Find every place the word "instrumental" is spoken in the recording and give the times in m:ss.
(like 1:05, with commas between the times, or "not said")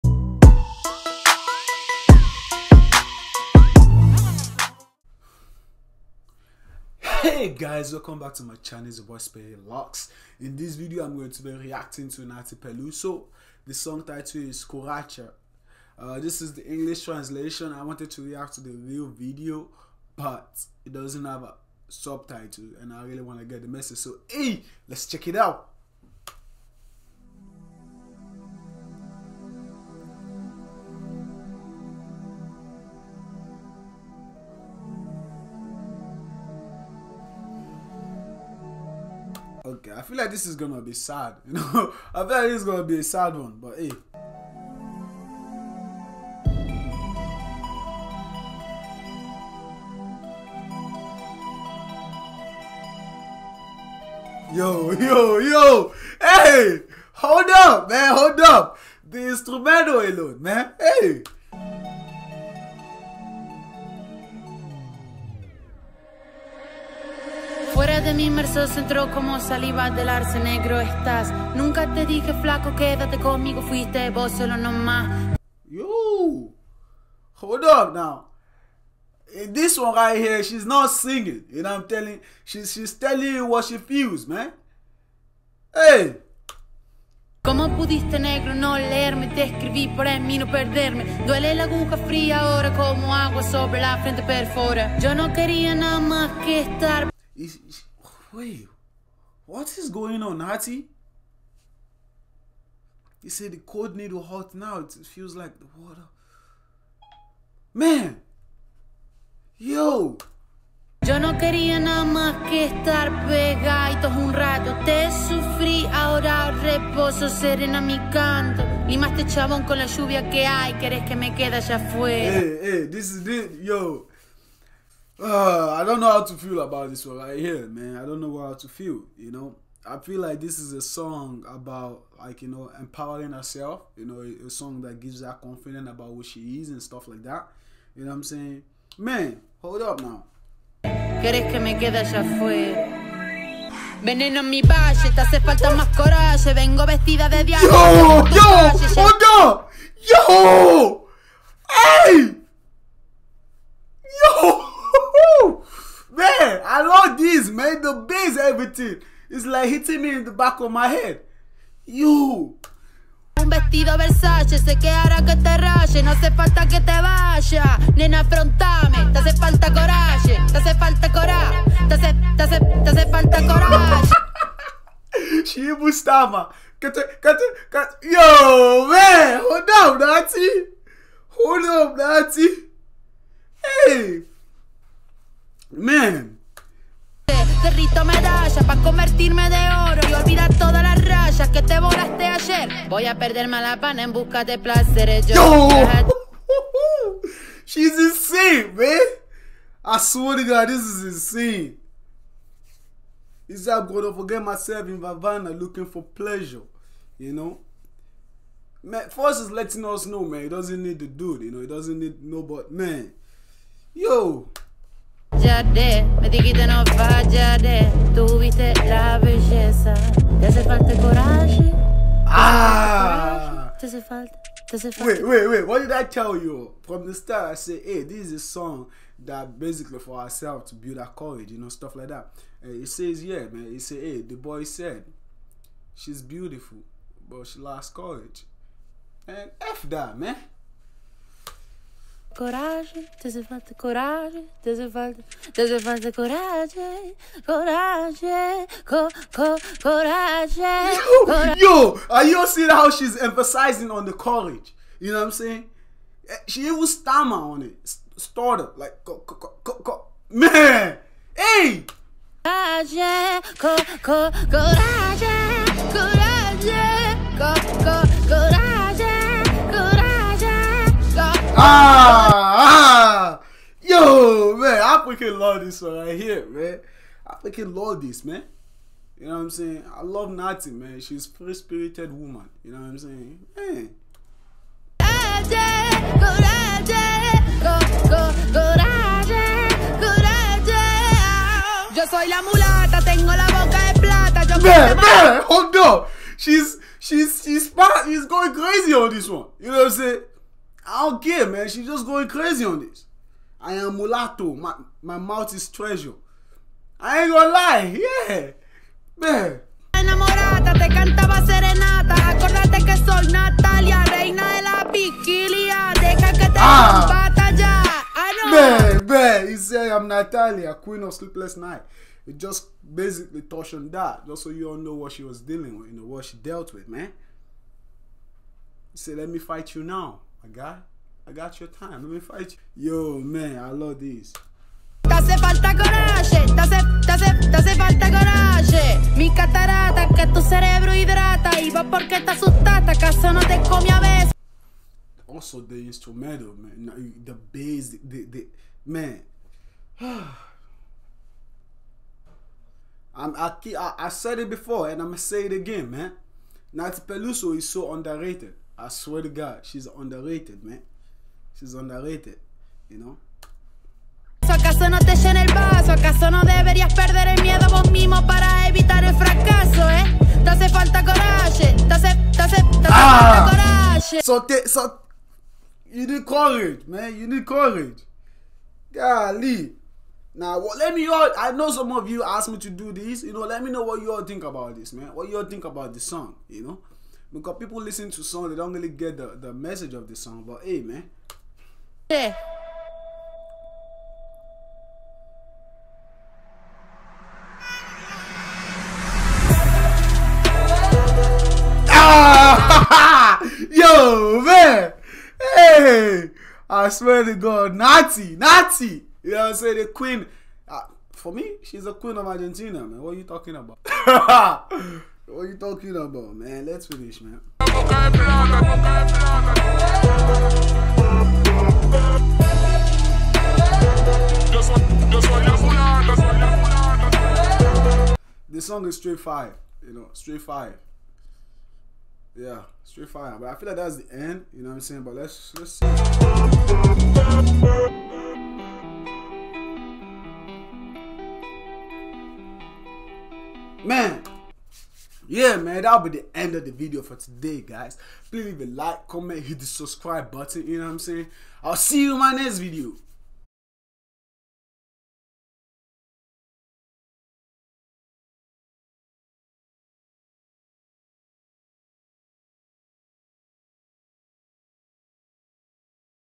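0:59, 5:45.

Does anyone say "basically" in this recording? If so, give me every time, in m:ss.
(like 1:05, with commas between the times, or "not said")
3:49, 5:22.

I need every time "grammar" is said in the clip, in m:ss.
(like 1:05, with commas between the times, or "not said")
not said.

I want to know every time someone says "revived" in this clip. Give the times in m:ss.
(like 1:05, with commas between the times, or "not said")
not said.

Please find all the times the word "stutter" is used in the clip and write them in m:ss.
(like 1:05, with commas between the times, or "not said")
4:18.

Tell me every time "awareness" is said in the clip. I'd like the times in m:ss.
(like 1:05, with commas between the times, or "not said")
not said.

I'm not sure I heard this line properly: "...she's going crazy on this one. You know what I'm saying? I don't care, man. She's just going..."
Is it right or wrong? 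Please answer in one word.
right.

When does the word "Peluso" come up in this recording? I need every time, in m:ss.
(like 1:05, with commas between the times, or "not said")
0:12, 5:57.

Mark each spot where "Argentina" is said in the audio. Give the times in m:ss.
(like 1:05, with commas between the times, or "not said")
6:52.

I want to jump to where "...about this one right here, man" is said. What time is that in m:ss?
2:06.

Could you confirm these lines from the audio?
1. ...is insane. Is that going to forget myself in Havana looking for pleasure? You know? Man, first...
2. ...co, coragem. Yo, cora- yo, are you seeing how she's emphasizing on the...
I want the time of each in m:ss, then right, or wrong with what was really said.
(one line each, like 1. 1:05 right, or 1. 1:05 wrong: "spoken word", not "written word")
1. 3:20 right
2. 4:09 right.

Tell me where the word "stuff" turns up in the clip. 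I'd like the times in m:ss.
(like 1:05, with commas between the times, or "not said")
2:16, 3:51.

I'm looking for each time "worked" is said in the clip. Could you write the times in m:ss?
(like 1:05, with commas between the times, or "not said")
not said.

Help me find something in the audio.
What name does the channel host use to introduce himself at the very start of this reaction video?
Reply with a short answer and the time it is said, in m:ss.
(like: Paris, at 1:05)
Sperry Locks, at 0:09.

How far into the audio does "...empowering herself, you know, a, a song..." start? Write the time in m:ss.
2:12.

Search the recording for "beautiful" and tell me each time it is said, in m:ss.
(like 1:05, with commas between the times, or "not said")
3:56.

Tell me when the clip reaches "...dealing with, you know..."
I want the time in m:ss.
5:25.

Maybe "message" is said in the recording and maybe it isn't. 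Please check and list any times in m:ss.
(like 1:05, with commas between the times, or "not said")
0:23, 6:29.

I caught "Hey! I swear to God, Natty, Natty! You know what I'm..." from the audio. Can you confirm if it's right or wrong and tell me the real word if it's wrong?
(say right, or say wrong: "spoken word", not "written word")
right.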